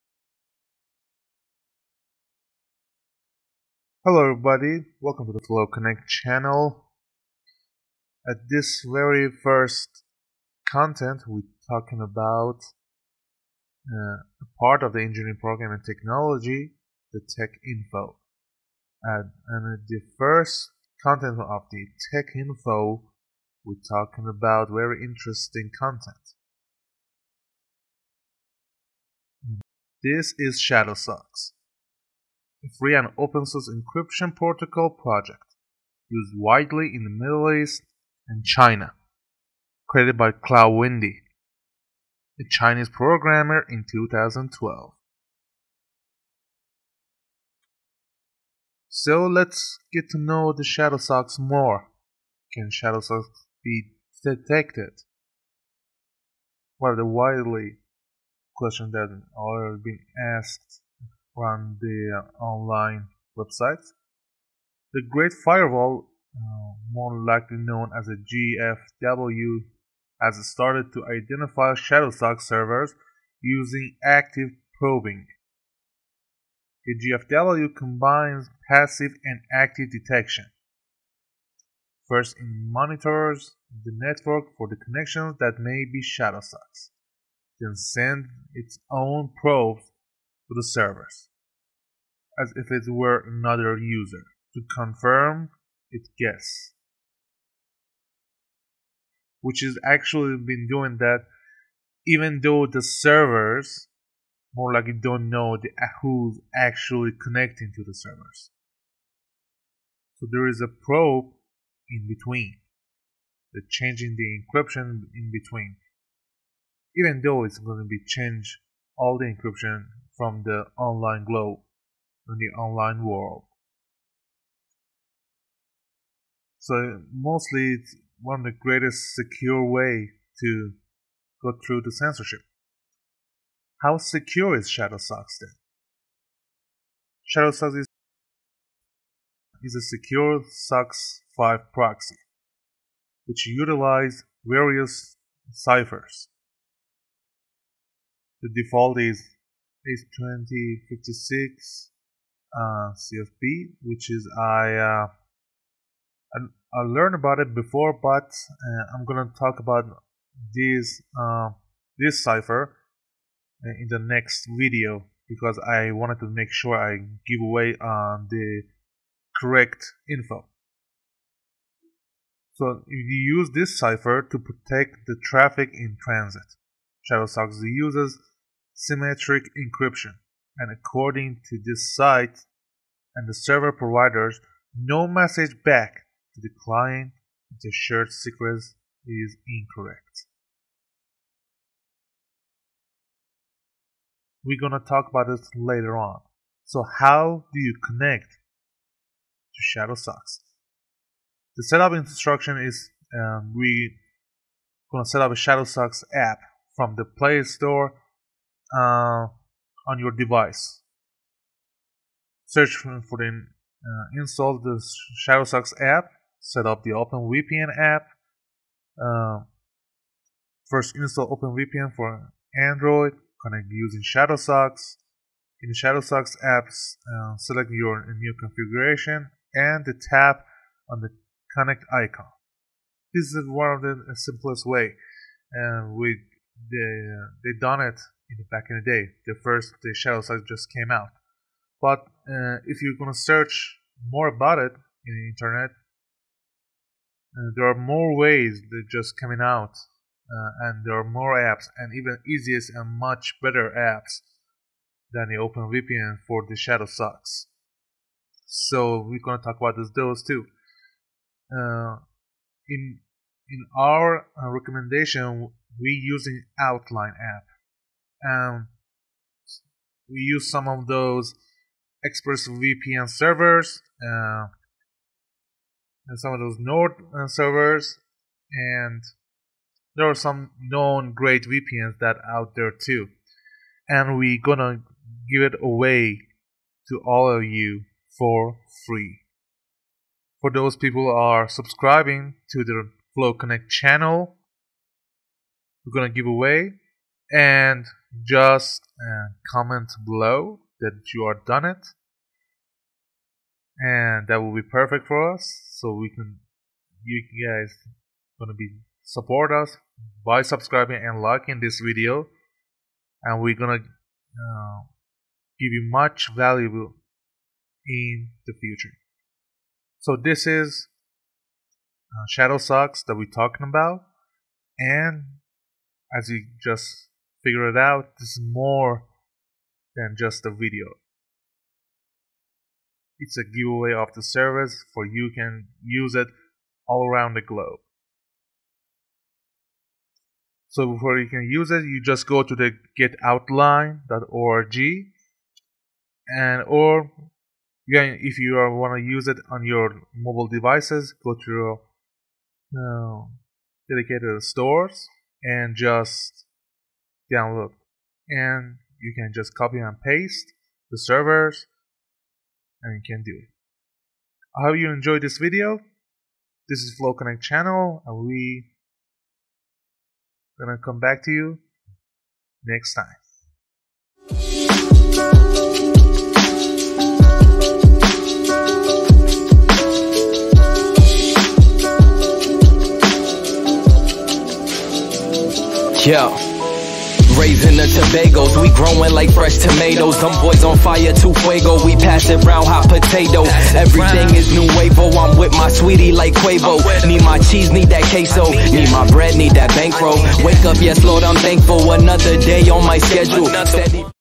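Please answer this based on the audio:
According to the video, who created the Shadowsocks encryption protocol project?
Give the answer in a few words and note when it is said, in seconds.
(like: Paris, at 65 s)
Cloud Windy, at 40 s.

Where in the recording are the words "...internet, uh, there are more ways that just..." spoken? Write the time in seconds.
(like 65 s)
245 s.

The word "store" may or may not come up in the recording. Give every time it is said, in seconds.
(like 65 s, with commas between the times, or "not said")
207 s, 354 s.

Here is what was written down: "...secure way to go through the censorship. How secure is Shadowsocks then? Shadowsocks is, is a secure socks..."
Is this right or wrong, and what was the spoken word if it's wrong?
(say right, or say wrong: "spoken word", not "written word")
right.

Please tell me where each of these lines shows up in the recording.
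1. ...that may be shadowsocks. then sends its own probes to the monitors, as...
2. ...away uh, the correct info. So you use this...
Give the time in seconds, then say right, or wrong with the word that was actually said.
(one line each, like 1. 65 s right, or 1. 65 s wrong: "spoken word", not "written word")
1. 85 s wrong: "servers", not "monitors"
2. 167 s right.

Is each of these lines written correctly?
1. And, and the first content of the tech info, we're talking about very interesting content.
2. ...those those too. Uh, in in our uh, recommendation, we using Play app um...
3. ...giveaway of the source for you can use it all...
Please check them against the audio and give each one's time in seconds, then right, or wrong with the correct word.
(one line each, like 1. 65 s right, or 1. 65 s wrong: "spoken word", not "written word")
1. 19 s right
2. 259 s wrong: "Outline", not "Play"
3. 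333 s wrong: "service", not "source".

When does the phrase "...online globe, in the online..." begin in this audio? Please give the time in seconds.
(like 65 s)
120 s.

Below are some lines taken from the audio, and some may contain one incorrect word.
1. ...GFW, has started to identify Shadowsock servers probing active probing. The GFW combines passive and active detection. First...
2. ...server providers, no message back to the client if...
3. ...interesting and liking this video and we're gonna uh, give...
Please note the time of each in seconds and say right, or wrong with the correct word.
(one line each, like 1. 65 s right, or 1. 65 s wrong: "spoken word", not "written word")
1. 68 s wrong: "using", not "probing"
2. 183 s right
3. 310 s wrong: "subscribing", not "interesting".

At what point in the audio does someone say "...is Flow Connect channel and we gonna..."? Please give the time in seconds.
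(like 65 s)
366 s.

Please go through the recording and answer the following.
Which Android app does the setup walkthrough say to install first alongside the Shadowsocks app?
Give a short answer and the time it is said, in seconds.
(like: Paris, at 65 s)
OpenVPN for Android, at 221 s.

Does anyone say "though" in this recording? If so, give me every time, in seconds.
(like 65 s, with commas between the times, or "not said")
102 s, 117 s.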